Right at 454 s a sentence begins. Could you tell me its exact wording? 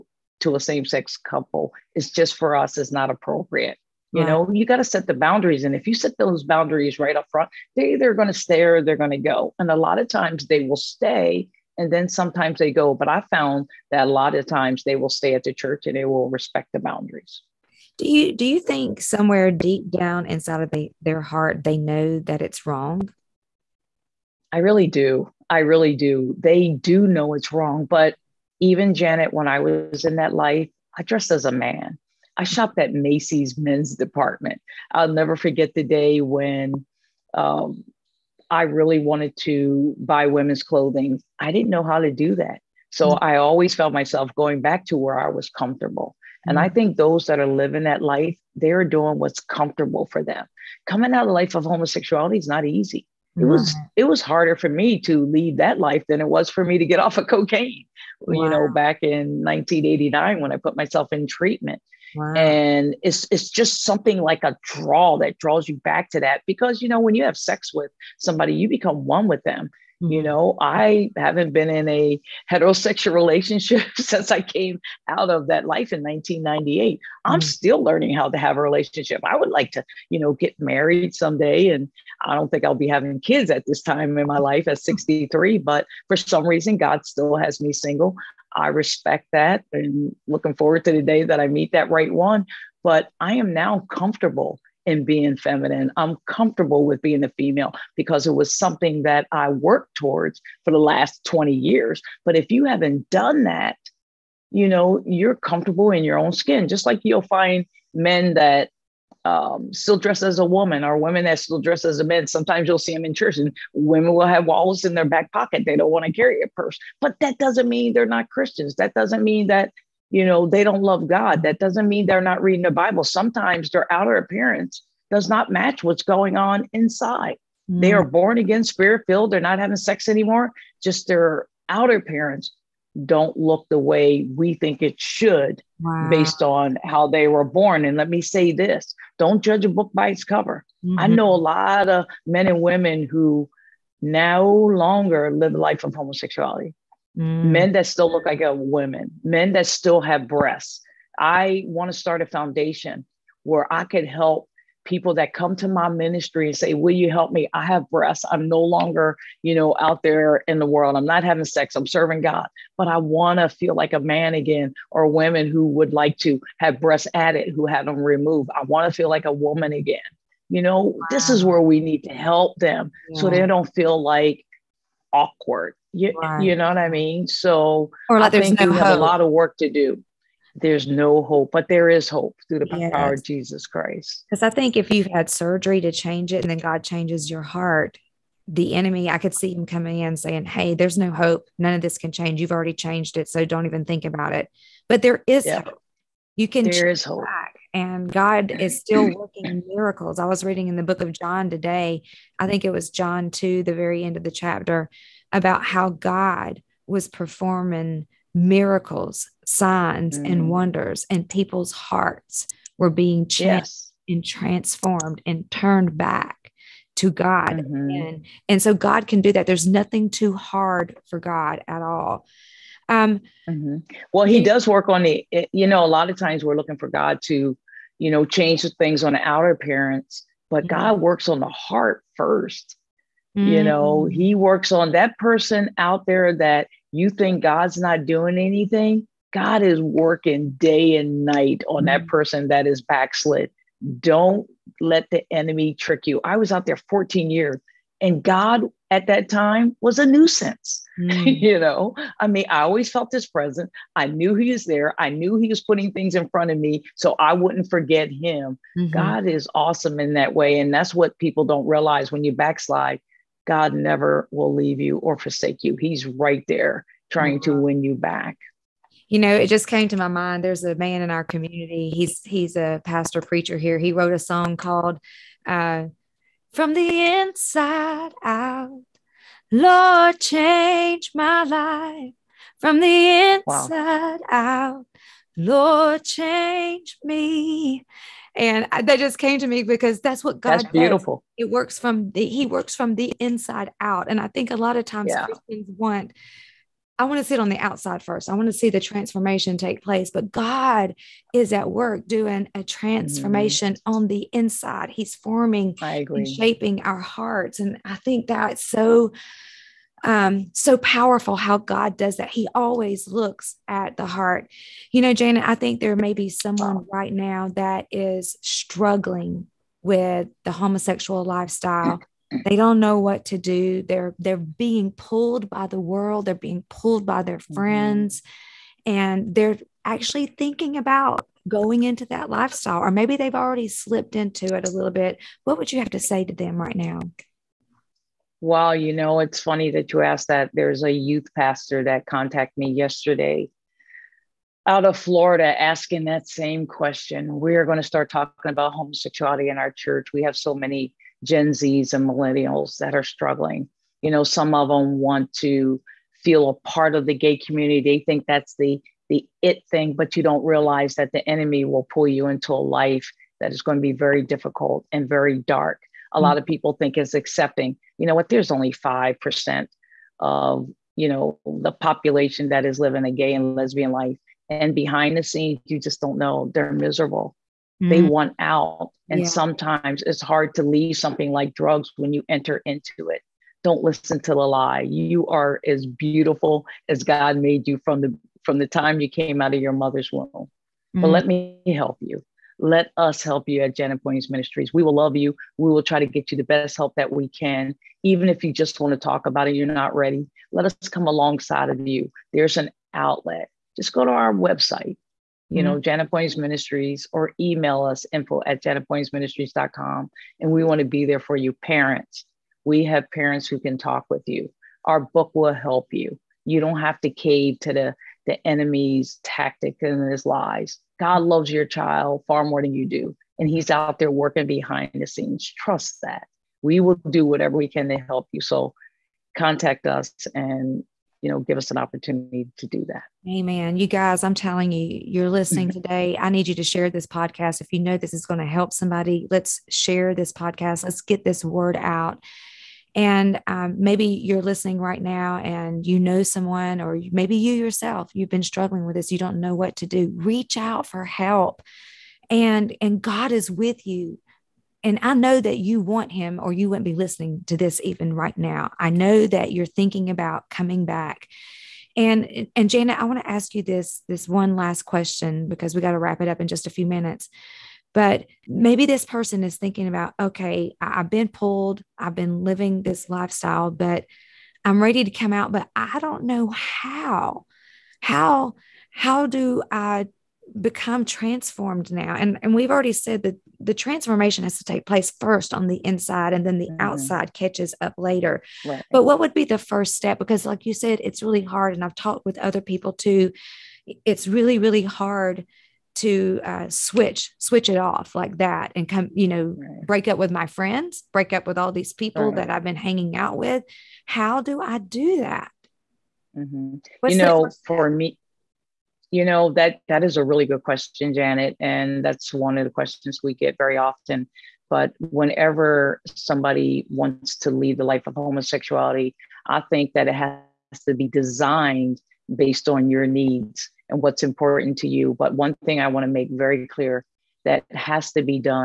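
And I know that you want him, or you wouldn't be listening to this even right now.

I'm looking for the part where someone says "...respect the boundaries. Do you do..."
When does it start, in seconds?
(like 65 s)
16 s.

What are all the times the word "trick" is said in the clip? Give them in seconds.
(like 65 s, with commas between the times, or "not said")
245 s.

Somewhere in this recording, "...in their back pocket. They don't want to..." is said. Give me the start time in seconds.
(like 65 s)
114 s.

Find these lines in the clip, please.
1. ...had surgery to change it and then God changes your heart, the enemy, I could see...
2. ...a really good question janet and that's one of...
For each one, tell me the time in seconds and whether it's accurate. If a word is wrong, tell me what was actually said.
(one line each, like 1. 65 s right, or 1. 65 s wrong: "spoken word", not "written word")
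1. 185 s right
2. 510 s right.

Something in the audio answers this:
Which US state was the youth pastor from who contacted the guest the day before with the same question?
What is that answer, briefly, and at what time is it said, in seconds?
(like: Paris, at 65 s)
Florida, at 344 s.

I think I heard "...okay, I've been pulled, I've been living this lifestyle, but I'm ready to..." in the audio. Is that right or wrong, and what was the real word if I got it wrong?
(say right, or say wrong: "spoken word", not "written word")
right.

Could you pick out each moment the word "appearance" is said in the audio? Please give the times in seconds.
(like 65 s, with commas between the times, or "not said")
124 s, 131 s, 229 s.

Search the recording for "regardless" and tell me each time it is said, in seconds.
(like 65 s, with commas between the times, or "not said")
not said.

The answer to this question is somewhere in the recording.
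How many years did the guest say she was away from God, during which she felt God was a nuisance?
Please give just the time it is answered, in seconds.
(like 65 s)
246 s.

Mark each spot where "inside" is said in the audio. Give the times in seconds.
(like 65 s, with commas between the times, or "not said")
20 s, 126 s, 277 s, 283 s, 293 s, 304 s, 485 s.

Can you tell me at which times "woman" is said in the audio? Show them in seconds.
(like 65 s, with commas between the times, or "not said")
110 s, 148 s, 169 s.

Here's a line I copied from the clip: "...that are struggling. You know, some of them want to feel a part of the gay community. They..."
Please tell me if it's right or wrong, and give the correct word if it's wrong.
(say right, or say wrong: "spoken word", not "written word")
right.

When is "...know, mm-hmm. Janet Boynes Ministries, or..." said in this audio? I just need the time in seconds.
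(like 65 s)
405 s.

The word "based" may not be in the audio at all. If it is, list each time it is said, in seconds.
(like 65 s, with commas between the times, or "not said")
136 s, 522 s.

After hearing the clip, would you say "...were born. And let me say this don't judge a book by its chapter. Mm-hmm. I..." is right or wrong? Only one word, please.
wrong.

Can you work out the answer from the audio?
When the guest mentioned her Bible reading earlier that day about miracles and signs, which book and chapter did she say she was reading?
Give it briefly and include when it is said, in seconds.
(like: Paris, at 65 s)
John 2, at 202 s.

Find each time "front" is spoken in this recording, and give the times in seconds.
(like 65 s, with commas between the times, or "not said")
7 s, 256 s.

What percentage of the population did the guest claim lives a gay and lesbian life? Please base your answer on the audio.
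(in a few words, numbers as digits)
5%.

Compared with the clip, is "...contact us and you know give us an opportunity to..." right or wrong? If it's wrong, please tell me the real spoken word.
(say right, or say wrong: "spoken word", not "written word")
right.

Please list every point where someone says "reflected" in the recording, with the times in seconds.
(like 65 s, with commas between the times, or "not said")
not said.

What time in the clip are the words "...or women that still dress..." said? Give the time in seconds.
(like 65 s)
110 s.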